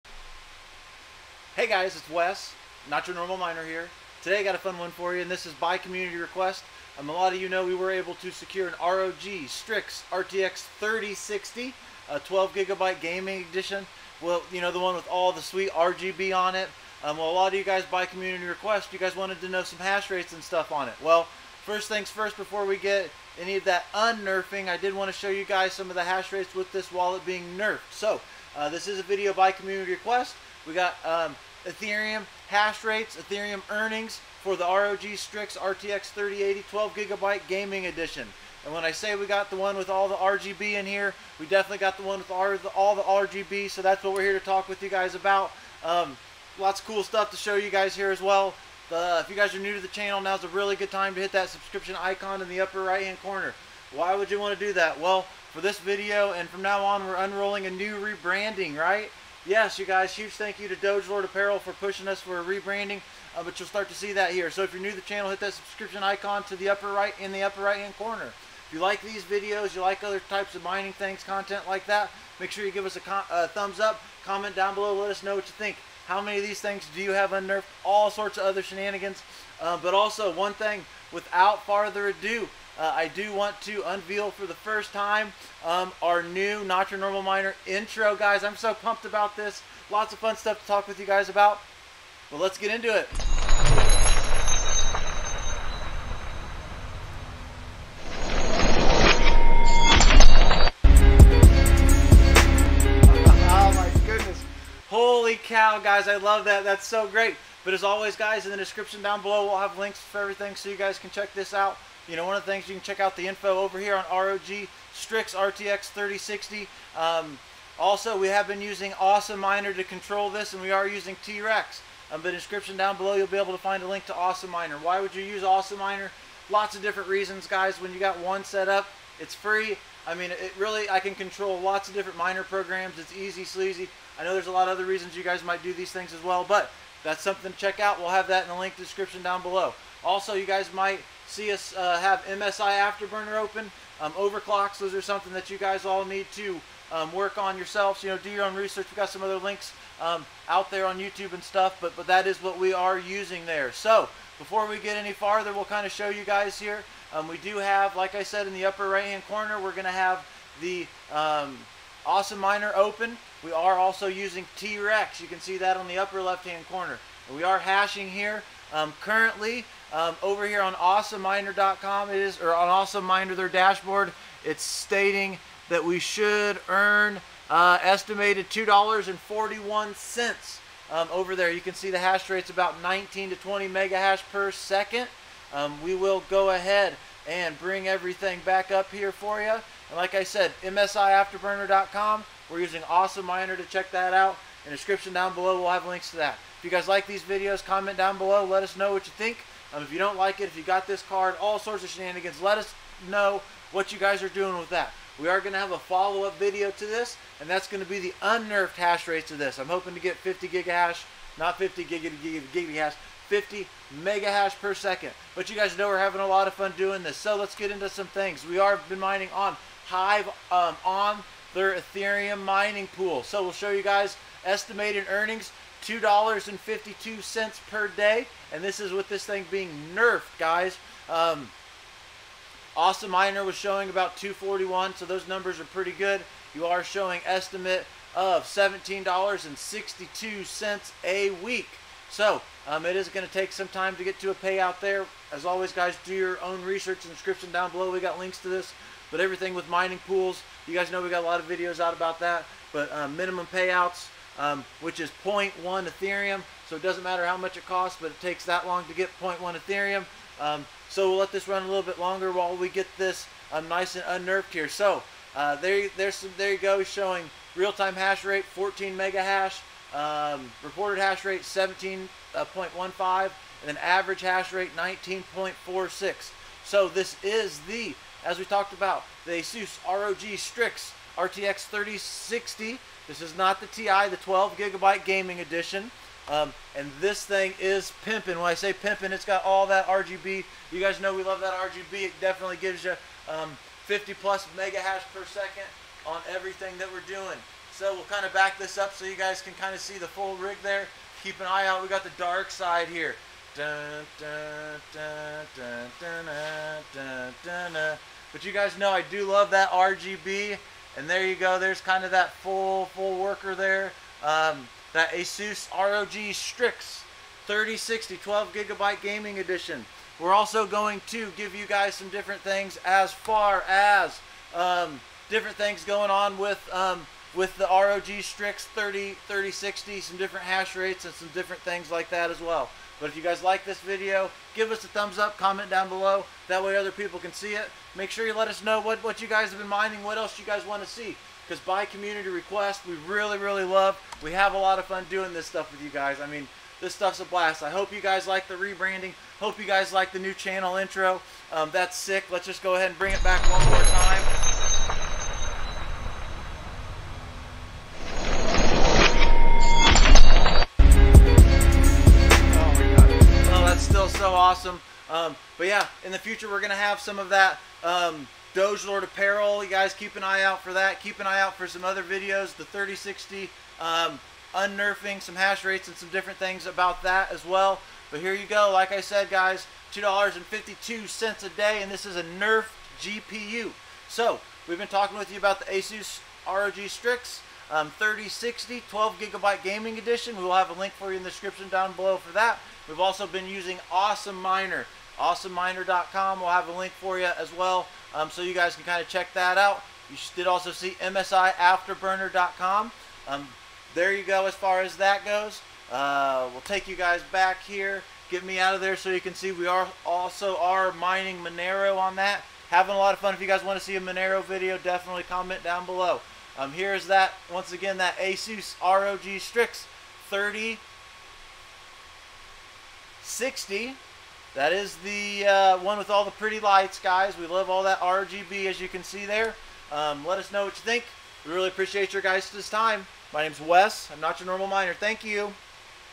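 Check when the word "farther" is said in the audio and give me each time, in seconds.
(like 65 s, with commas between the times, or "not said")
81 s, 155 s.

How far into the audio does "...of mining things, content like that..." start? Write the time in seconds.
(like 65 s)
70 s.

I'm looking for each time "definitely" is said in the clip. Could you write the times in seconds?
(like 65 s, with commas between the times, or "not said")
41 s, 292 s, 414 s.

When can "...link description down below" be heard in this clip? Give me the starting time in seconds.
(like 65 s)
138 s.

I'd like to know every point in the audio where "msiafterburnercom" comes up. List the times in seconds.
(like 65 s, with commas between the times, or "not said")
190 s, 400 s.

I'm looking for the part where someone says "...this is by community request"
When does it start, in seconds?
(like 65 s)
5 s.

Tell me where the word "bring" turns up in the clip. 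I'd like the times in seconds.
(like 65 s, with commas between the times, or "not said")
187 s, 352 s.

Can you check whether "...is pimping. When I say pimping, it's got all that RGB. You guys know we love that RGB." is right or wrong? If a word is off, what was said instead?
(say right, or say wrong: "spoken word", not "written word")
right.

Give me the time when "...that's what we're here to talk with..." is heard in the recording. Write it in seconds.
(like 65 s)
43 s.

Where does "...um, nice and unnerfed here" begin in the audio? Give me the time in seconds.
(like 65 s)
263 s.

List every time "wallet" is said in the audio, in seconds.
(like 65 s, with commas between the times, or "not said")
26 s.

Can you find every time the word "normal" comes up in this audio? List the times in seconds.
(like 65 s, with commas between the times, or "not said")
3 s, 86 s, 434 s.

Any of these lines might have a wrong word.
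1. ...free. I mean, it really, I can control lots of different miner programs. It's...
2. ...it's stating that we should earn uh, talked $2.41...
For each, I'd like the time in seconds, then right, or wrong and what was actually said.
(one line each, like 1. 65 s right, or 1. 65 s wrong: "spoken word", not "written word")
1. 129 s right
2. 174 s wrong: "estimated", not "talked".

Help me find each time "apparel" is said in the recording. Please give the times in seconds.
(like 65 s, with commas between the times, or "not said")
61 s, 369 s.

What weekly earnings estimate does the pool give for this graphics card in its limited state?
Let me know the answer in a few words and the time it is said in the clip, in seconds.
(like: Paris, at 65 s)
$17.62, at 238 s.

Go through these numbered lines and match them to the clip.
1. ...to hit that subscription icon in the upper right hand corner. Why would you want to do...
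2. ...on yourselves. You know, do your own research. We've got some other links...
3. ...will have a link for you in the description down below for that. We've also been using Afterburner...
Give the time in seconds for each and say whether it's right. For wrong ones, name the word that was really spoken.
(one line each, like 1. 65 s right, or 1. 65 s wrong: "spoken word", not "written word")
1. 51 s right
2. 147 s right
3. 390 s wrong: "Awesome", not "Afterburner".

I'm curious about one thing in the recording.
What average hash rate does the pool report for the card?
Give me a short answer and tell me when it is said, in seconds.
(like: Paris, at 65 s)
19.46, at 274 s.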